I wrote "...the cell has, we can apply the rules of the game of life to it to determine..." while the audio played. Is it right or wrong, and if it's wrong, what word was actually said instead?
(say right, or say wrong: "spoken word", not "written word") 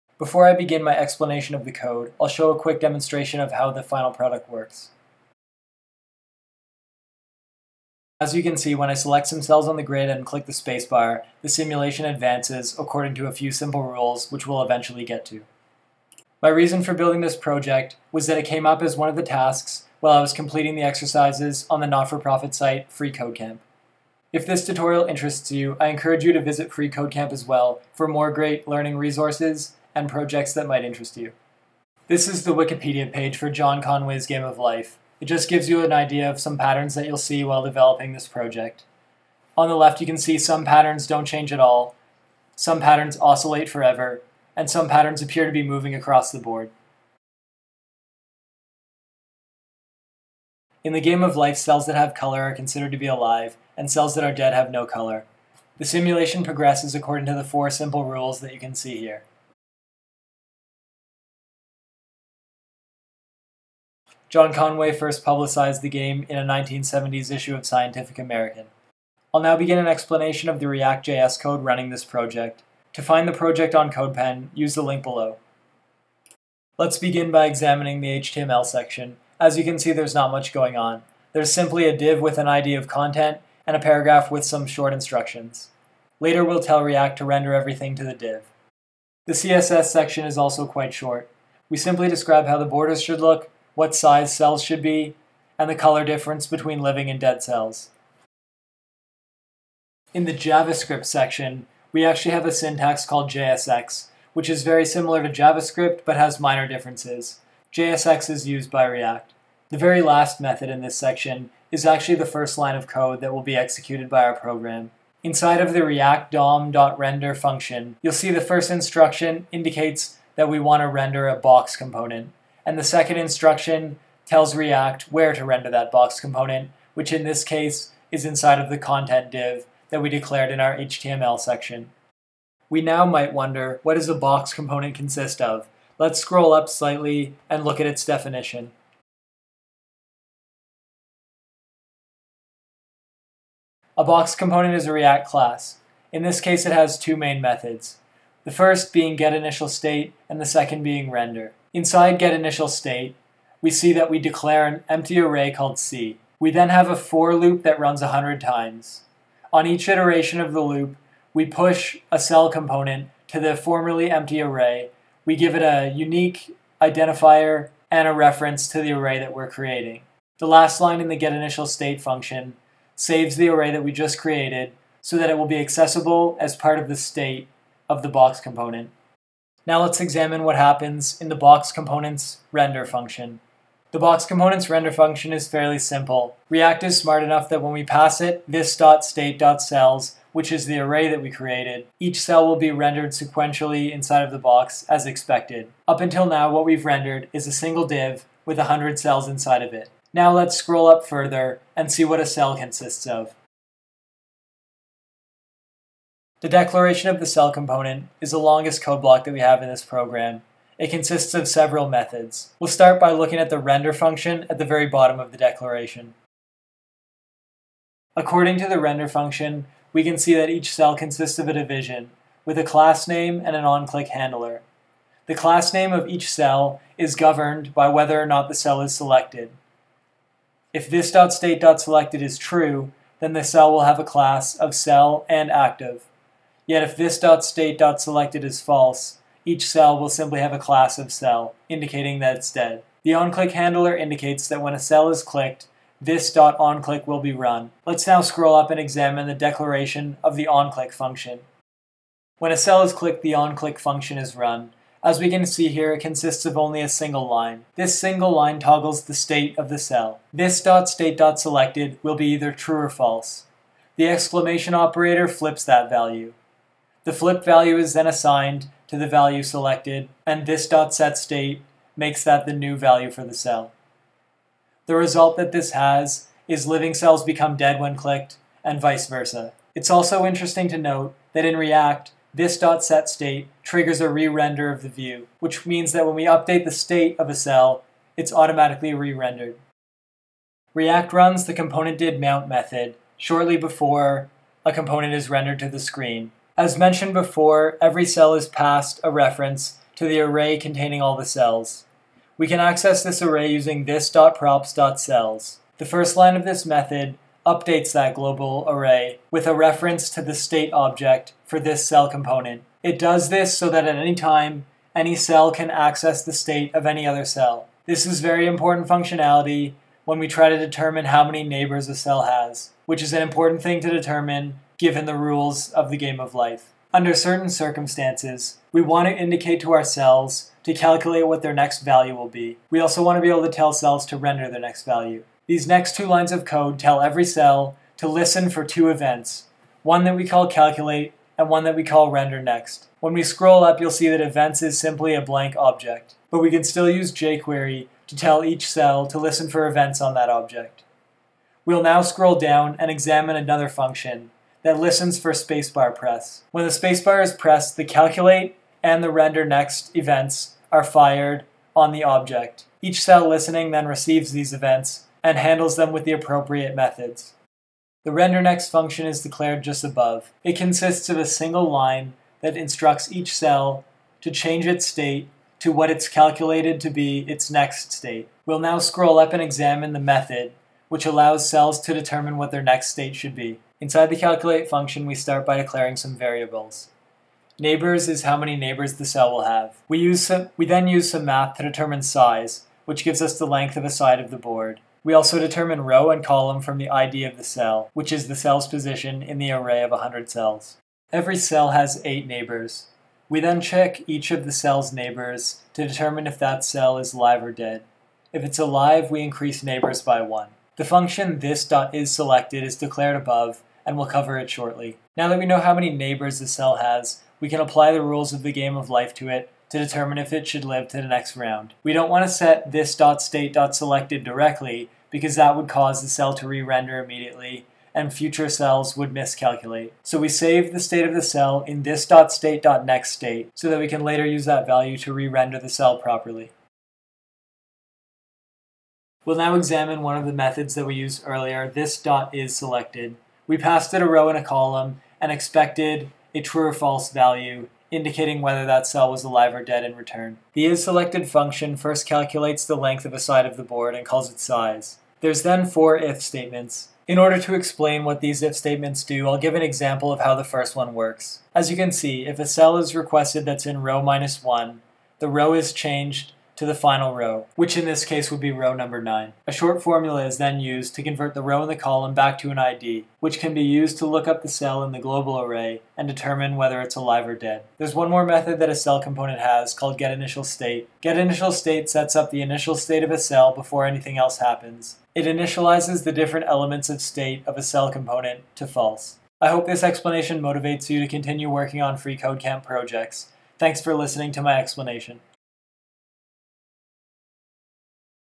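right.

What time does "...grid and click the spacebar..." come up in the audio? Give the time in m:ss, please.
0:09.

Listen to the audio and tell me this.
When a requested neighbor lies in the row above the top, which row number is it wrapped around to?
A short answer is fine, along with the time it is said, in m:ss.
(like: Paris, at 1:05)
9, at 7:48.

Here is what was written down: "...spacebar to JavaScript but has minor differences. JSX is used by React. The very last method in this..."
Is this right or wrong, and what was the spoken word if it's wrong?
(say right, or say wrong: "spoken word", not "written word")
wrong: "similar", not "spacebar".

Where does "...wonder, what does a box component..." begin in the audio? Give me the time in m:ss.
2:13.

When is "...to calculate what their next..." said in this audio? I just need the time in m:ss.
5:30.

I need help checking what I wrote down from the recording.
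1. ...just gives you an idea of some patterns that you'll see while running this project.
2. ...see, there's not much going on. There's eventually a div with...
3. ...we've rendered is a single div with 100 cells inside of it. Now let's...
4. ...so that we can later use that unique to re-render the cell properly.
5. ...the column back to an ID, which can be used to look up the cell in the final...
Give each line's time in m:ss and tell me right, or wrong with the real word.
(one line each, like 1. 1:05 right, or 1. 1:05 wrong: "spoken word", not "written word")
1. 0:35 wrong: "developing", not "running"
2. 1:19 wrong: "simply", not "eventually"
3. 3:16 right
4. 7:13 wrong: "value", not "unique"
5. 7:51 wrong: "global", not "final".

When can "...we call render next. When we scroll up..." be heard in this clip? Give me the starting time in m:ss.
5:41.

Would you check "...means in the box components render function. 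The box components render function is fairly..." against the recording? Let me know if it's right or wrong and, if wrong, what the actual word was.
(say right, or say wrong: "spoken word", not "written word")
wrong: "happens", not "means".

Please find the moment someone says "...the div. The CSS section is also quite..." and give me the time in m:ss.
1:28.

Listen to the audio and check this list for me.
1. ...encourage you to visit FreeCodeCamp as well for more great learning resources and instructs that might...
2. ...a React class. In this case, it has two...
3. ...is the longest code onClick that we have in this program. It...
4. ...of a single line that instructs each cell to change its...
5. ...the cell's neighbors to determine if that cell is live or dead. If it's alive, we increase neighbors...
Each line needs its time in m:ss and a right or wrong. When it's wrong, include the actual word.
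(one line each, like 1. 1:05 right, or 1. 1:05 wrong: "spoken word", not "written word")
1. 0:25 wrong: "projects", not "instructs"
2. 2:24 right
3. 3:28 wrong: "block", not "onClick"
4. 6:11 right
5. 6:44 right.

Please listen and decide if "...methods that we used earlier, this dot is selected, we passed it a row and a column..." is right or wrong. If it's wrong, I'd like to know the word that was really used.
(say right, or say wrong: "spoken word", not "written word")
right.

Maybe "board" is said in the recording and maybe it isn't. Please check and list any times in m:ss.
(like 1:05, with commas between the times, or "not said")
0:46, 6:34, 7:33.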